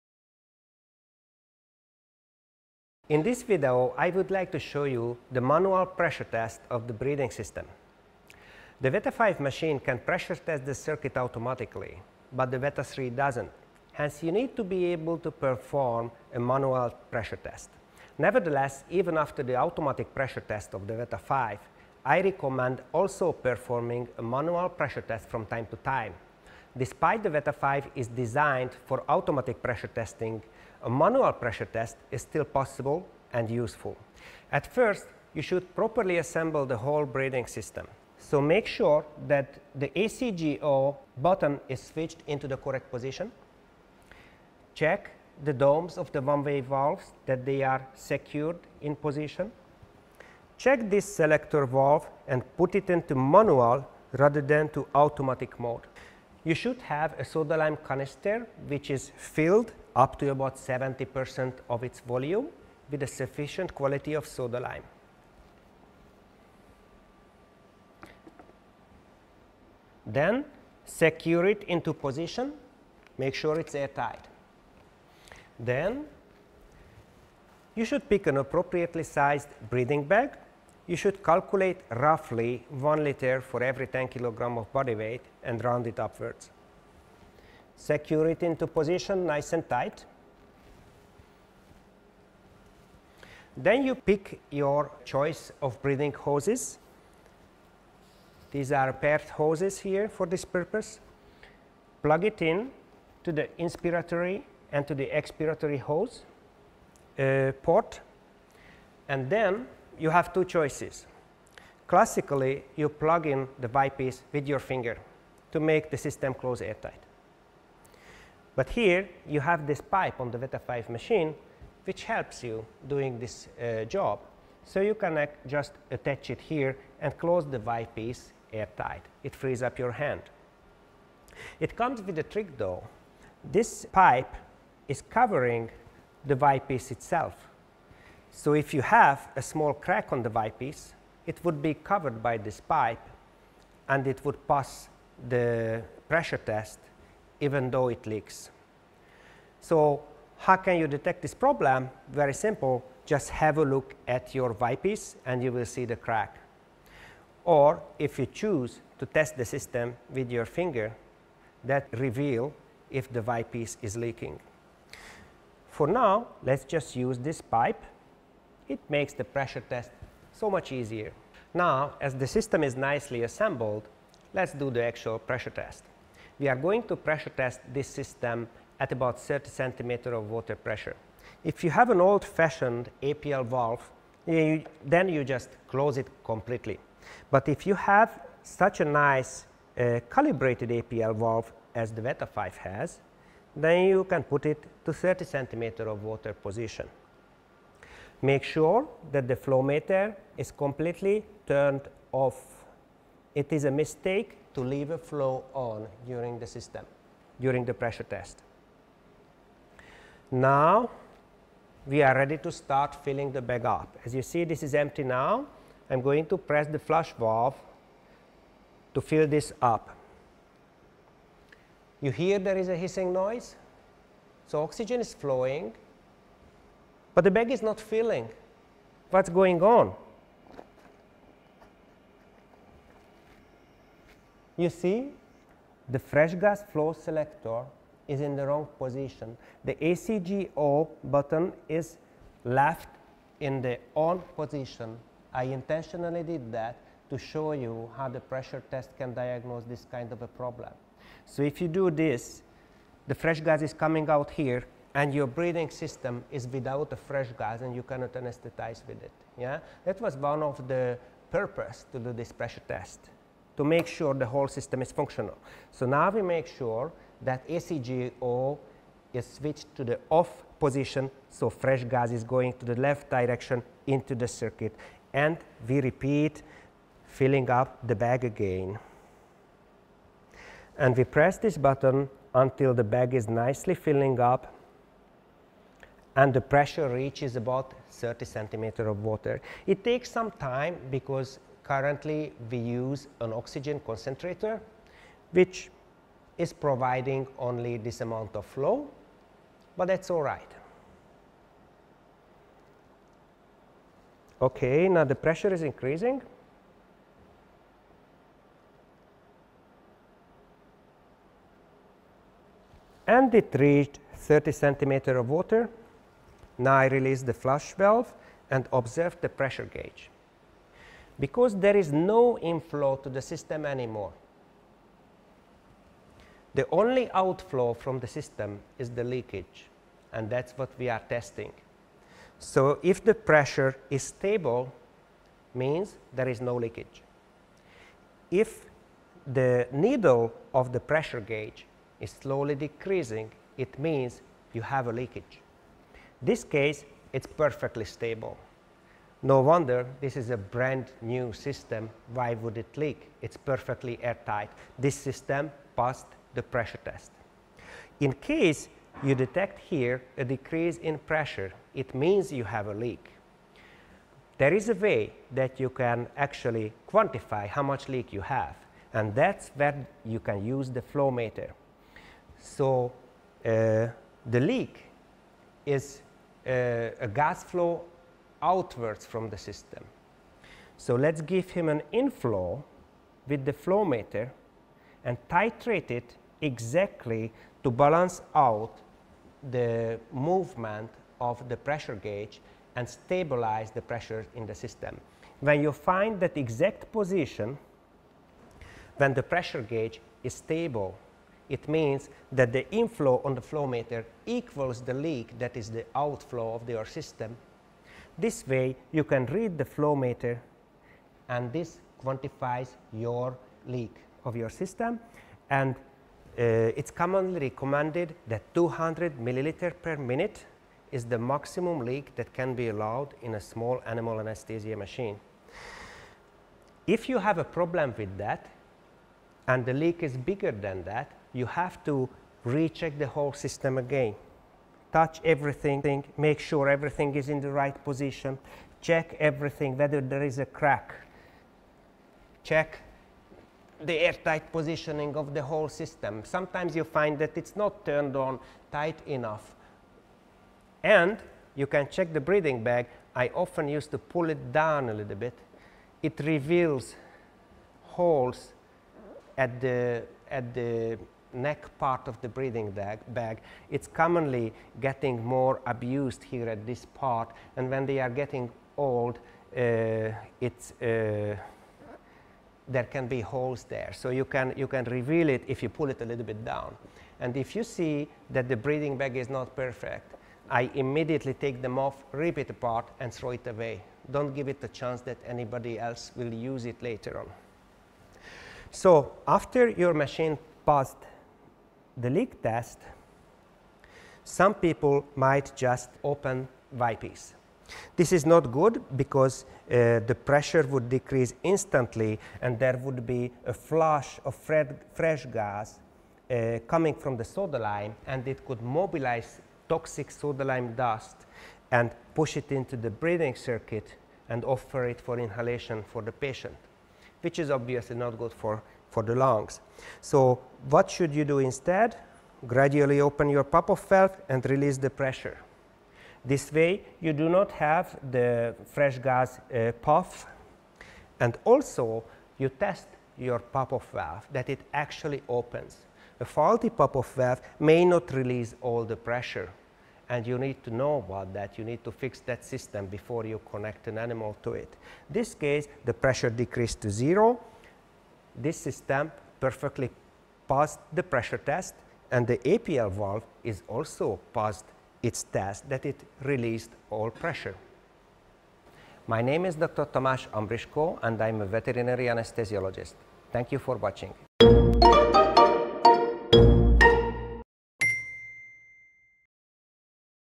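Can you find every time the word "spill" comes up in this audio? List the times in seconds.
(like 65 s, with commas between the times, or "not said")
not said.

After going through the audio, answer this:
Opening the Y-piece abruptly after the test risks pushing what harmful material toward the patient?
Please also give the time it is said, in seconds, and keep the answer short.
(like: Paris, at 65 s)
soda lime dust, at 510 s.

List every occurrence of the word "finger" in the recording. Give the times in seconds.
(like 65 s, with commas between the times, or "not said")
114 s, 160 s.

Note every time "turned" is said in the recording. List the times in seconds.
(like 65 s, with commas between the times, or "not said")
201 s, 447 s.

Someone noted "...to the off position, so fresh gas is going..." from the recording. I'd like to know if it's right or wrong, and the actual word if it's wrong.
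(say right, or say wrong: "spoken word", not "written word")
right.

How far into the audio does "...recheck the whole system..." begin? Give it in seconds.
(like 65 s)
432 s.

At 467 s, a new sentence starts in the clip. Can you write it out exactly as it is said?
And when they are getting old, uh, it's, uh, there can be holes there.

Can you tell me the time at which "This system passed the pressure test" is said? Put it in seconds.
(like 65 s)
354 s.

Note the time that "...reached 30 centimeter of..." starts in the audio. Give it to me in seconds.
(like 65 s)
313 s.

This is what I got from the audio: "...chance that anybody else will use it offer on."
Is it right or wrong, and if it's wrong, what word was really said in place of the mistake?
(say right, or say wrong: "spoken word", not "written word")
wrong: "later", not "offer".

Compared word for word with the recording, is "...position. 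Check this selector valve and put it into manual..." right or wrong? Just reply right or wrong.
right.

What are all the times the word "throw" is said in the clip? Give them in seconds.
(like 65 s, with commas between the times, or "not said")
483 s.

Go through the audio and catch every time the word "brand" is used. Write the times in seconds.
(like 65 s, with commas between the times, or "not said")
350 s.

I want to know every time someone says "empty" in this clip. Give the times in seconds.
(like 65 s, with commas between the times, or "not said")
214 s.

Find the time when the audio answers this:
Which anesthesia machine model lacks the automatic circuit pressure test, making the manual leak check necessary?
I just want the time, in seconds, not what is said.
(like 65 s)
12 s.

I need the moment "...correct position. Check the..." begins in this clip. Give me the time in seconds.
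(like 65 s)
42 s.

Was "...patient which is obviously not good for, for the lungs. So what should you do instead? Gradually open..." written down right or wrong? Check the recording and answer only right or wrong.
right.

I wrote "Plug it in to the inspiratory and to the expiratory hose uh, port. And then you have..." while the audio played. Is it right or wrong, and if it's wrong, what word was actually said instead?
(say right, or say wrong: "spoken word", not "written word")
right.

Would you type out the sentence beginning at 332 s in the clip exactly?
So if the pressure is stable, means there is no leakage.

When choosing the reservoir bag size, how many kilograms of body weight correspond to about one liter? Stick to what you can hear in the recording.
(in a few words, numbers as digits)
10 kilograms.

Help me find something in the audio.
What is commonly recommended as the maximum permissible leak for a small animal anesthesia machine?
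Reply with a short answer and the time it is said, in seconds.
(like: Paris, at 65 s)
200 ml per minute, at 418 s.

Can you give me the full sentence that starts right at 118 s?
But here you have this pipe on the Veta 5 machine which helps you doing this uh, job.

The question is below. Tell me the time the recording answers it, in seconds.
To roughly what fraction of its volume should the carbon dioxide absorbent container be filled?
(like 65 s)
60 s.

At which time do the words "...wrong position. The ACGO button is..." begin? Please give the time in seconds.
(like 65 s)
238 s.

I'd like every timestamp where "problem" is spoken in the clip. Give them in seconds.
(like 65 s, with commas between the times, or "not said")
151 s, 250 s, 427 s.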